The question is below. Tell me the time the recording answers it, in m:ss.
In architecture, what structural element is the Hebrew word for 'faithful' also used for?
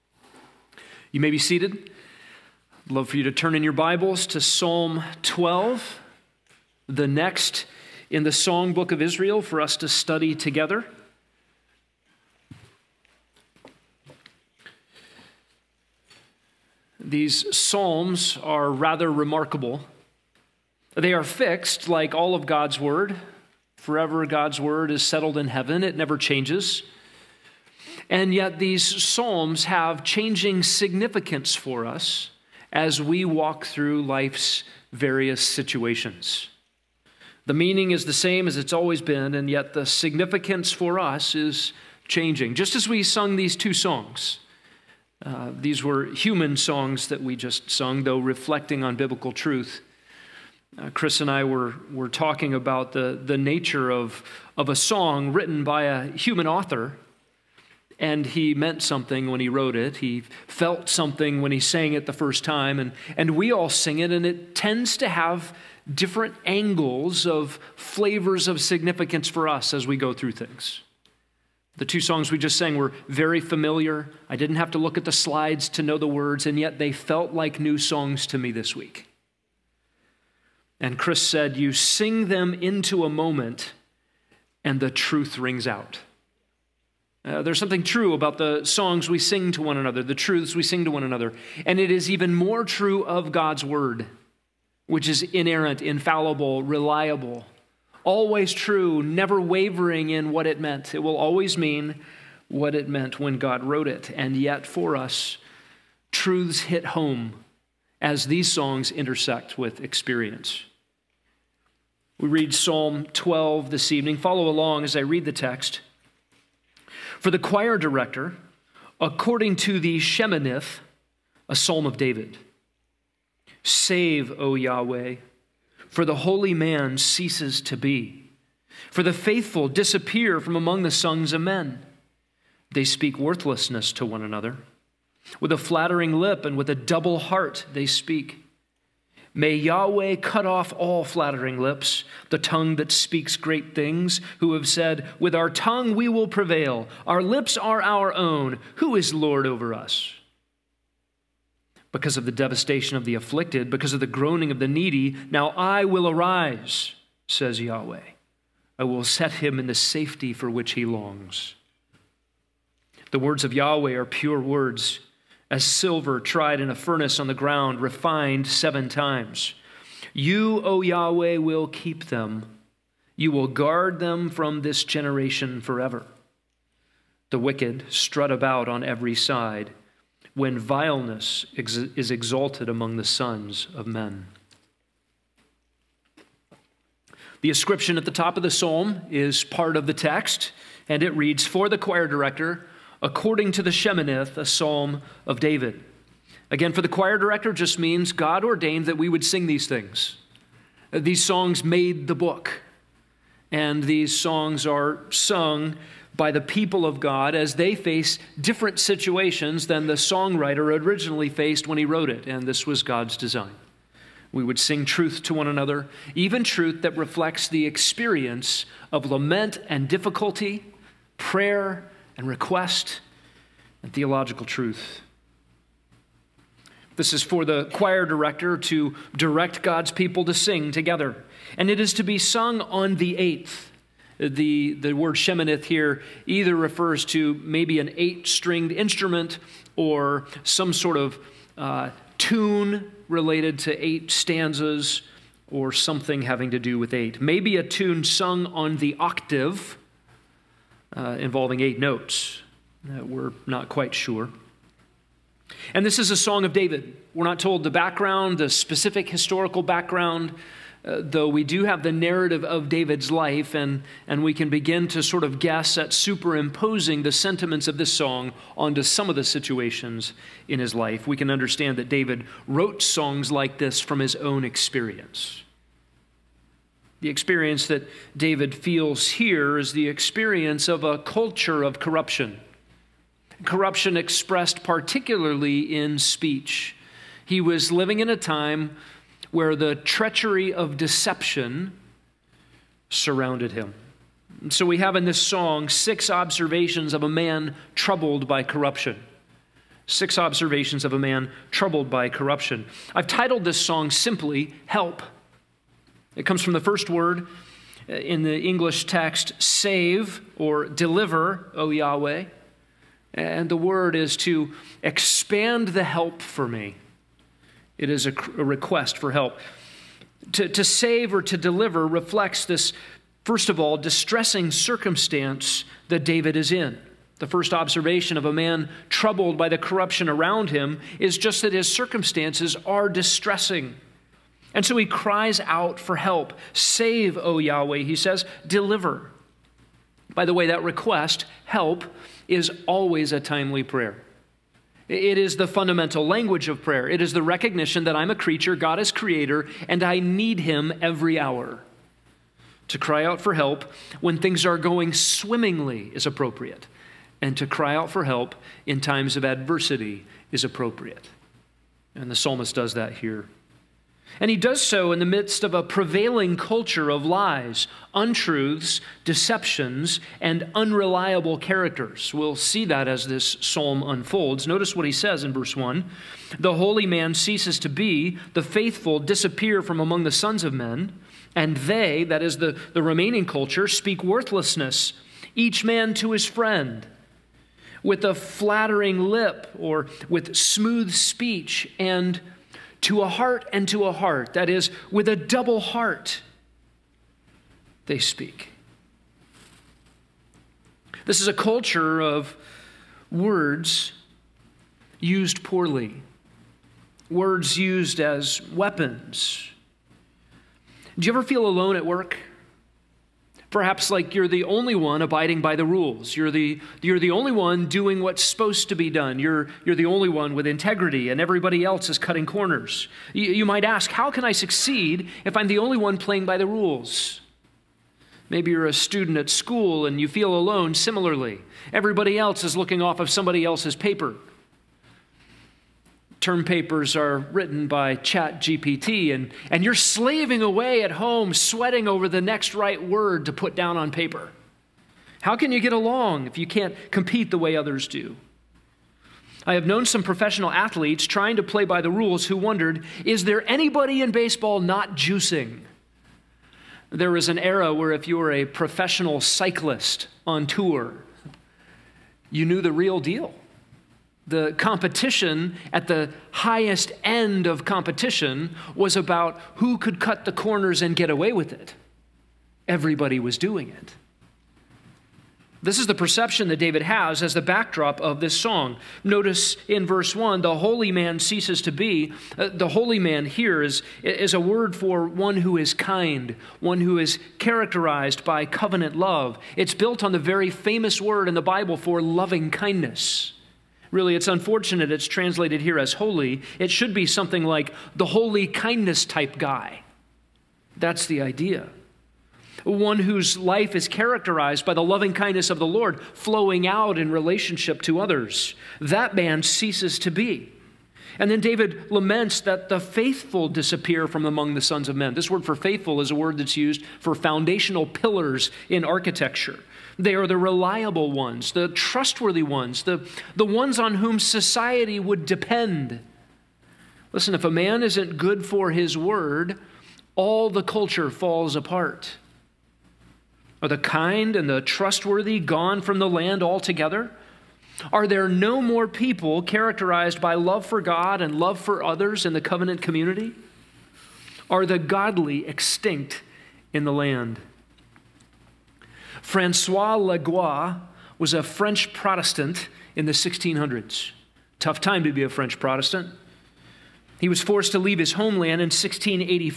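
8:37.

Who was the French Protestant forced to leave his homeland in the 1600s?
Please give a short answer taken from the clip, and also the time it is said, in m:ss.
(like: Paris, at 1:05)
Francois Leguat, at 9:09.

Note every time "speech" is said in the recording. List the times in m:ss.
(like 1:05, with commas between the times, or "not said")
4:45, 6:30.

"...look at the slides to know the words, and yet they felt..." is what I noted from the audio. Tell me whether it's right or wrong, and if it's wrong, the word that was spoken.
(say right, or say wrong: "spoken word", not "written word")
right.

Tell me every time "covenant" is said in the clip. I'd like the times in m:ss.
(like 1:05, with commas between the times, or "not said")
8:08, 9:02.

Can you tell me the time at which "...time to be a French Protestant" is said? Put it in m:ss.
9:14.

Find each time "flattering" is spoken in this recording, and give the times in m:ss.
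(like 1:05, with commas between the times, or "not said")
2:15, 2:21, 6:28.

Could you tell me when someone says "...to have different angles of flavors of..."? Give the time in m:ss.
1:04.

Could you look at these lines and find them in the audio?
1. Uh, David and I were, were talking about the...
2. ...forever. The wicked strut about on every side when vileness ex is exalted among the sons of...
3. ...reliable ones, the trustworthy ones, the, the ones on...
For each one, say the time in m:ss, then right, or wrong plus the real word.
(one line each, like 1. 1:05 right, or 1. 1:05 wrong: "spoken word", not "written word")
1. 0:50 wrong: "Chris", not "David"
2. 2:55 right
3. 8:40 right.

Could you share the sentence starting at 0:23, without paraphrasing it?
Forever, God's Word is settled in heaven, it never changes.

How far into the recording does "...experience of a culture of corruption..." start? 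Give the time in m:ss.
4:39.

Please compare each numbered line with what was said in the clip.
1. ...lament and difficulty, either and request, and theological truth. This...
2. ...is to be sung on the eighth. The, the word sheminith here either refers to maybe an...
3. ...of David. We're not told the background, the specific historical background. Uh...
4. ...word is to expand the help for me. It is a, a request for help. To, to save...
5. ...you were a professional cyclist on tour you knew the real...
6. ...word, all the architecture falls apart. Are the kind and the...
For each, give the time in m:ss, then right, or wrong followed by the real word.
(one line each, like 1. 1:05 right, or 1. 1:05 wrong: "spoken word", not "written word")
1. 3:39 wrong: "prayer", not "either"
2. 3:51 right
3. 4:16 right
4. 5:13 right
5. 7:38 right
6. 8:48 wrong: "culture", not "architecture".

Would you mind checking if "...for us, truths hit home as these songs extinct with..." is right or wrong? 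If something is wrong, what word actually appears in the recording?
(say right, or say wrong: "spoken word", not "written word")
wrong: "intersect", not "extinct".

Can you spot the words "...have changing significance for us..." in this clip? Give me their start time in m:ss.
0:29.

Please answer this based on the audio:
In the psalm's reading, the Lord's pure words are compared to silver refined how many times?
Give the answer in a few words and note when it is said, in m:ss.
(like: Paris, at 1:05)
7, at 2:48.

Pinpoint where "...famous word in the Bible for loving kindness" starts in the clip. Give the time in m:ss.
8:10.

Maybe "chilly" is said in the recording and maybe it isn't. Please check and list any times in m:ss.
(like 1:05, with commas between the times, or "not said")
not said.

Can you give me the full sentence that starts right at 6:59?
You're, you're the only one with integrity, and everybody else is cutting corners.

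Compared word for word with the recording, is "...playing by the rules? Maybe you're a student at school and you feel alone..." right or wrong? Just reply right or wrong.
right.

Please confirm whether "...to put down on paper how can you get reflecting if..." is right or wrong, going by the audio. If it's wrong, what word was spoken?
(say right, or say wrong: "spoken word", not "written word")
wrong: "along", not "reflecting".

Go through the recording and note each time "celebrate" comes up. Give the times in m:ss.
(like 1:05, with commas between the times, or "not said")
not said.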